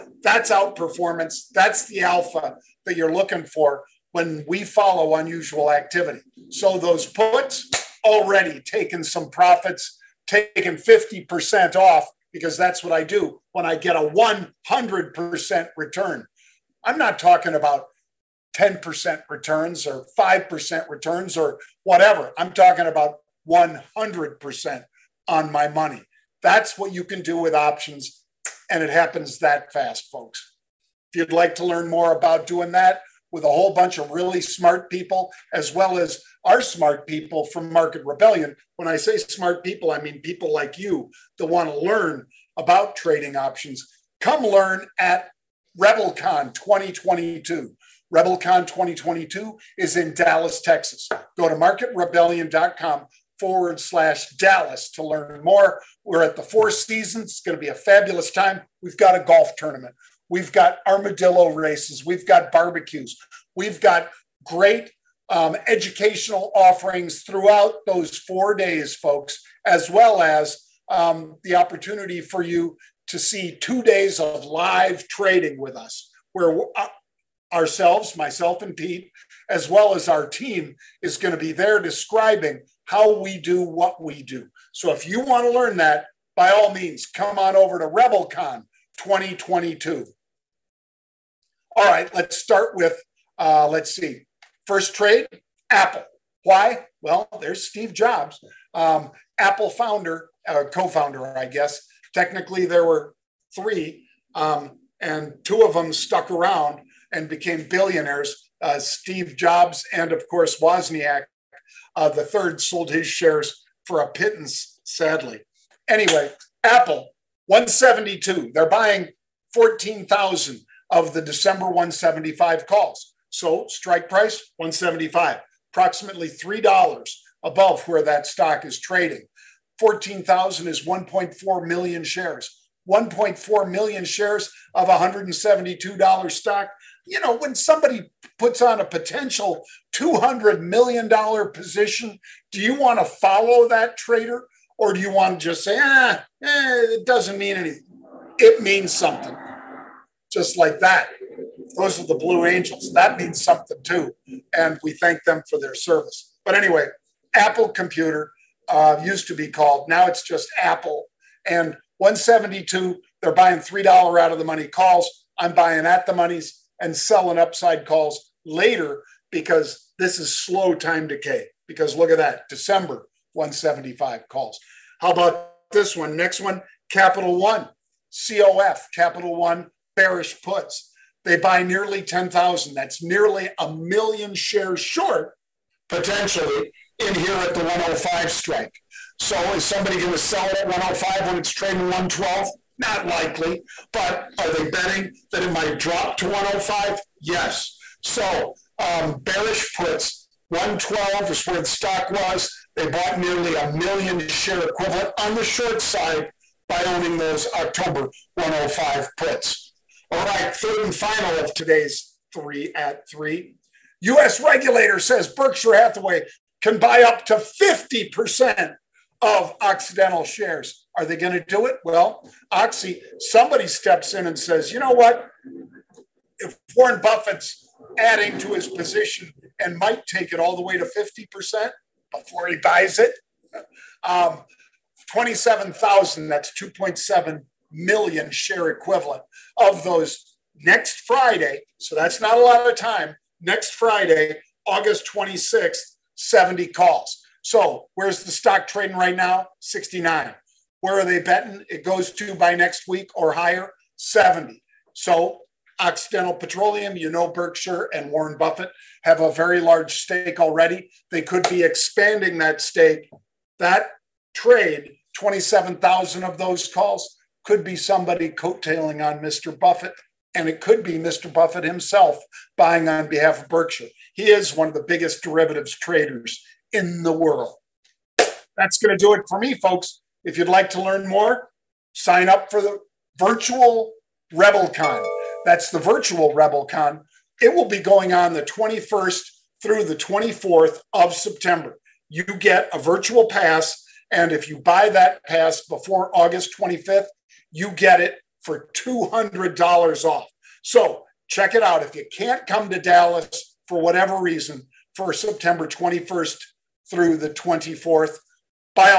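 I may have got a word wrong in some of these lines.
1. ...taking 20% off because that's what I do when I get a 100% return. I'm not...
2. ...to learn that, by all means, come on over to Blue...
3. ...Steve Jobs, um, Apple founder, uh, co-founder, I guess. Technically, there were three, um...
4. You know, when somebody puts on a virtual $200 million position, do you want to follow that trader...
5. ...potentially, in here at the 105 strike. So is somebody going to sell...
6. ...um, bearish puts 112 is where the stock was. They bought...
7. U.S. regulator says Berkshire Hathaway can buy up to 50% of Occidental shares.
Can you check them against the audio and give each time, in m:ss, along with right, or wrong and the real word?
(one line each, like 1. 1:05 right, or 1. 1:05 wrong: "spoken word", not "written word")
1. 0:10 wrong: "50", not "20"
2. 1:25 wrong: "RebelCon", not "Blue"
3. 1:37 right
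4. 2:17 wrong: "potential", not "virtual"
5. 3:05 right
6. 3:18 right
7. 3:34 right.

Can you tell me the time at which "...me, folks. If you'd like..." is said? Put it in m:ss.
4:39.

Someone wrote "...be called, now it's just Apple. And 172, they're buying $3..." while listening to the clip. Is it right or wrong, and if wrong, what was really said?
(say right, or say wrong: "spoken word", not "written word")
right.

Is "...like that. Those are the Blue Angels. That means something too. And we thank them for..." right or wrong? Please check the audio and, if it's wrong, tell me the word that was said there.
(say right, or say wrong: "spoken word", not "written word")
right.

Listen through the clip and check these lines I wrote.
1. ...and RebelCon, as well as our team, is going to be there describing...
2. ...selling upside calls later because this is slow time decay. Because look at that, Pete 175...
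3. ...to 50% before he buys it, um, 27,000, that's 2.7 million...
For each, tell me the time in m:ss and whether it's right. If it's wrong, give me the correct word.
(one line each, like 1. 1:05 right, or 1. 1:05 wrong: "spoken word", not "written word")
1. 1:18 wrong: "Pete", not "RebelCon"
2. 2:46 wrong: "December", not "Pete"
3. 3:50 right.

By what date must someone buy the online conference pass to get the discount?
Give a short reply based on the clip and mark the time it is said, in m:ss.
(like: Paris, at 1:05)
August 25th, at 4:56.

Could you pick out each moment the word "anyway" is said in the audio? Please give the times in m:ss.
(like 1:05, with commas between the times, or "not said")
1:55, 2:36.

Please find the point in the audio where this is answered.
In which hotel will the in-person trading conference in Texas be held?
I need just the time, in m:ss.
0:56.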